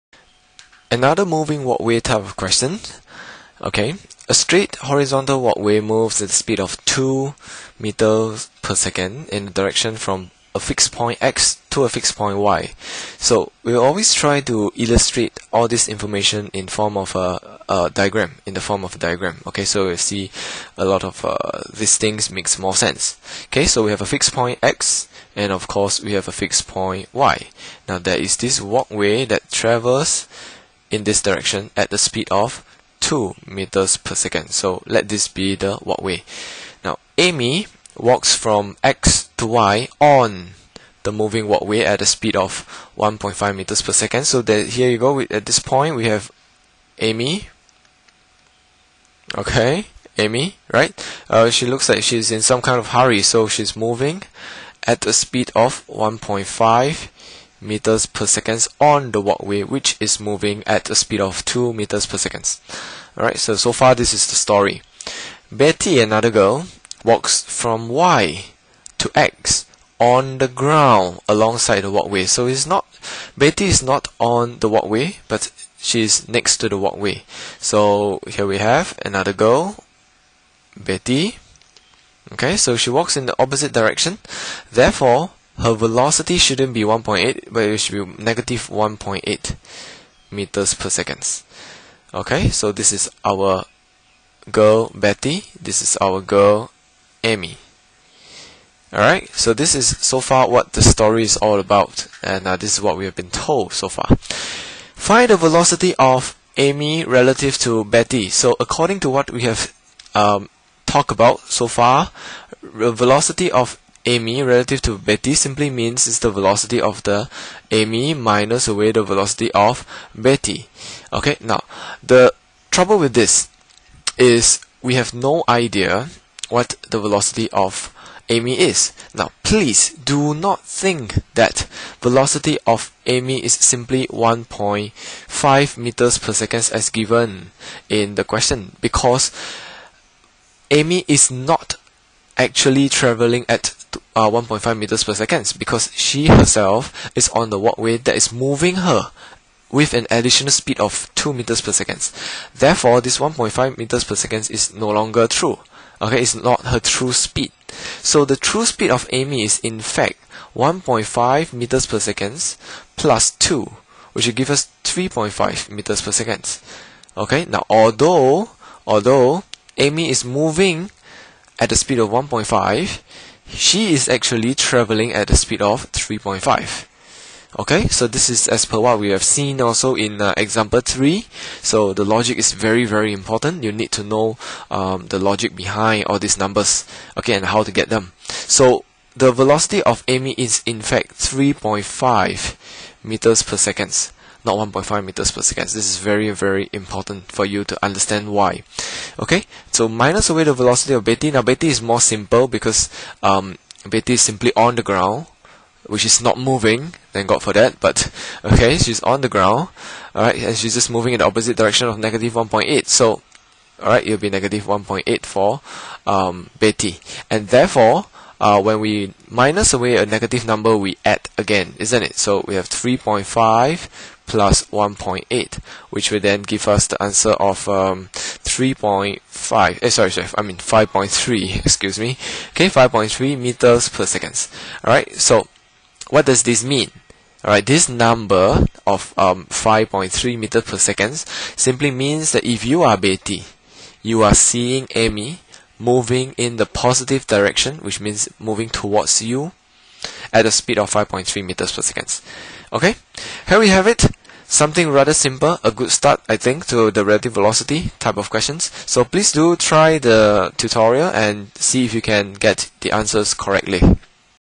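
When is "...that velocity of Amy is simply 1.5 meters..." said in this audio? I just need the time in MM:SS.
02:11.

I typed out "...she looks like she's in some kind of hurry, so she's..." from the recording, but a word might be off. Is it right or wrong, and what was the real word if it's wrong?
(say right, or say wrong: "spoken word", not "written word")
right.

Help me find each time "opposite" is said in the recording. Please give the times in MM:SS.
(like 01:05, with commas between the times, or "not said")
01:23, 03:31.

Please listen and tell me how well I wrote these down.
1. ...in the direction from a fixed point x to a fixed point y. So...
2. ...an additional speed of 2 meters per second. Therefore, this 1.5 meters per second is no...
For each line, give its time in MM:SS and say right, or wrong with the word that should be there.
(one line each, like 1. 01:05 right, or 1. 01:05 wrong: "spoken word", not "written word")
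1. 00:09 right
2. 02:29 right.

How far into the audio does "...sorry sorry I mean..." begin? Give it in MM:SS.
03:49.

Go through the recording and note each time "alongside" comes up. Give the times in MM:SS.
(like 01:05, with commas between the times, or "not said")
01:11.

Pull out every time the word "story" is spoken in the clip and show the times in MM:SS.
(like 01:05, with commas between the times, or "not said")
01:04, 01:40.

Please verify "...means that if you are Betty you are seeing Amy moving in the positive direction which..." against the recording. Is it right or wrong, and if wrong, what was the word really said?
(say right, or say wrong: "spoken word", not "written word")
right.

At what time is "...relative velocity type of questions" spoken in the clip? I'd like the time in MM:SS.
04:17.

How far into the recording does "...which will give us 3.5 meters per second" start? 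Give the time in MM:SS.
02:44.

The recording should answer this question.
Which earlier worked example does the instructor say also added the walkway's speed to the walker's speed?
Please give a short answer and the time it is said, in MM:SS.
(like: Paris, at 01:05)
example 3, at 03:00.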